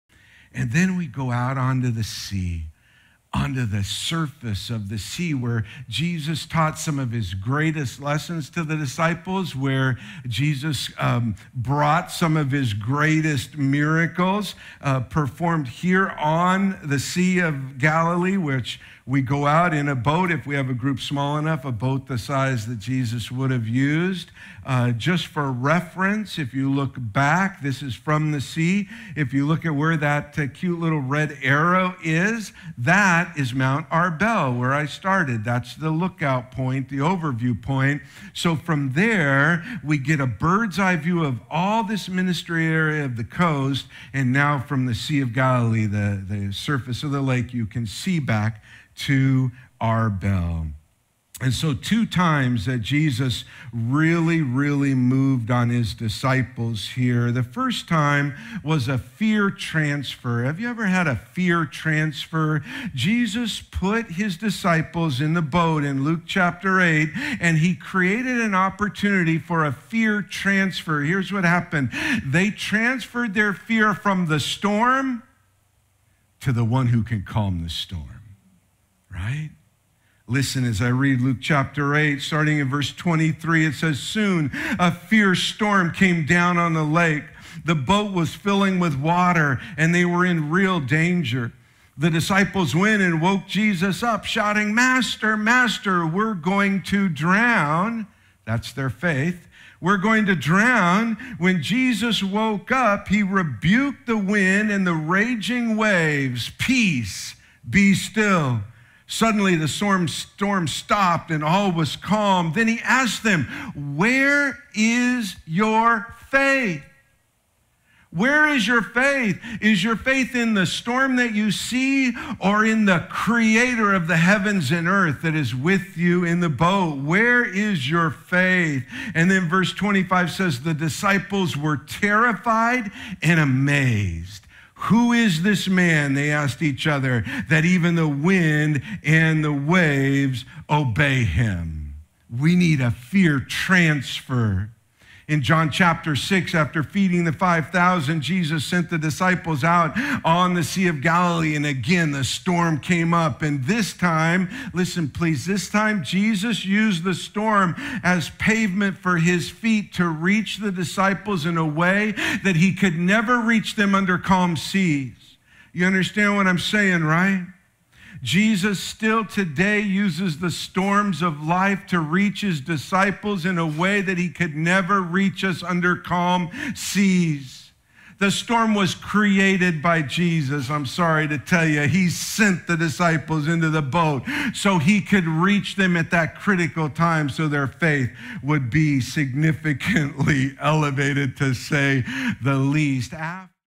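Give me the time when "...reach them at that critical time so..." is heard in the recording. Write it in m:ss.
3:05.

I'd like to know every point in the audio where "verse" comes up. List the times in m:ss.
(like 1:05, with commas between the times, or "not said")
1:22, 2:09.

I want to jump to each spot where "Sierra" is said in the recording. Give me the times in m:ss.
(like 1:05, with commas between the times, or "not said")
not said.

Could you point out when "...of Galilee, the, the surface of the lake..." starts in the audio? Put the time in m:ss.
0:45.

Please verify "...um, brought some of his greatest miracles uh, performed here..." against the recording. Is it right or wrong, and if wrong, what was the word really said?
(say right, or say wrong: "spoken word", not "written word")
right.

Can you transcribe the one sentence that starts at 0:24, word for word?
Uh, just for reference, if you look back, this is from the sea.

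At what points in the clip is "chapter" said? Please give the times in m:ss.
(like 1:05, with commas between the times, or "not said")
1:06, 1:21, 2:25.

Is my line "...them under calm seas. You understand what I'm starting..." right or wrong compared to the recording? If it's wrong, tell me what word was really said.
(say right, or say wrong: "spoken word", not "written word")
wrong: "saying", not "starting".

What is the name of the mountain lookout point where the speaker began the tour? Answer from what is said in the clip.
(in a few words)
Mount Arbel.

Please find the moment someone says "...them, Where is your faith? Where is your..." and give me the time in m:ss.
1:53.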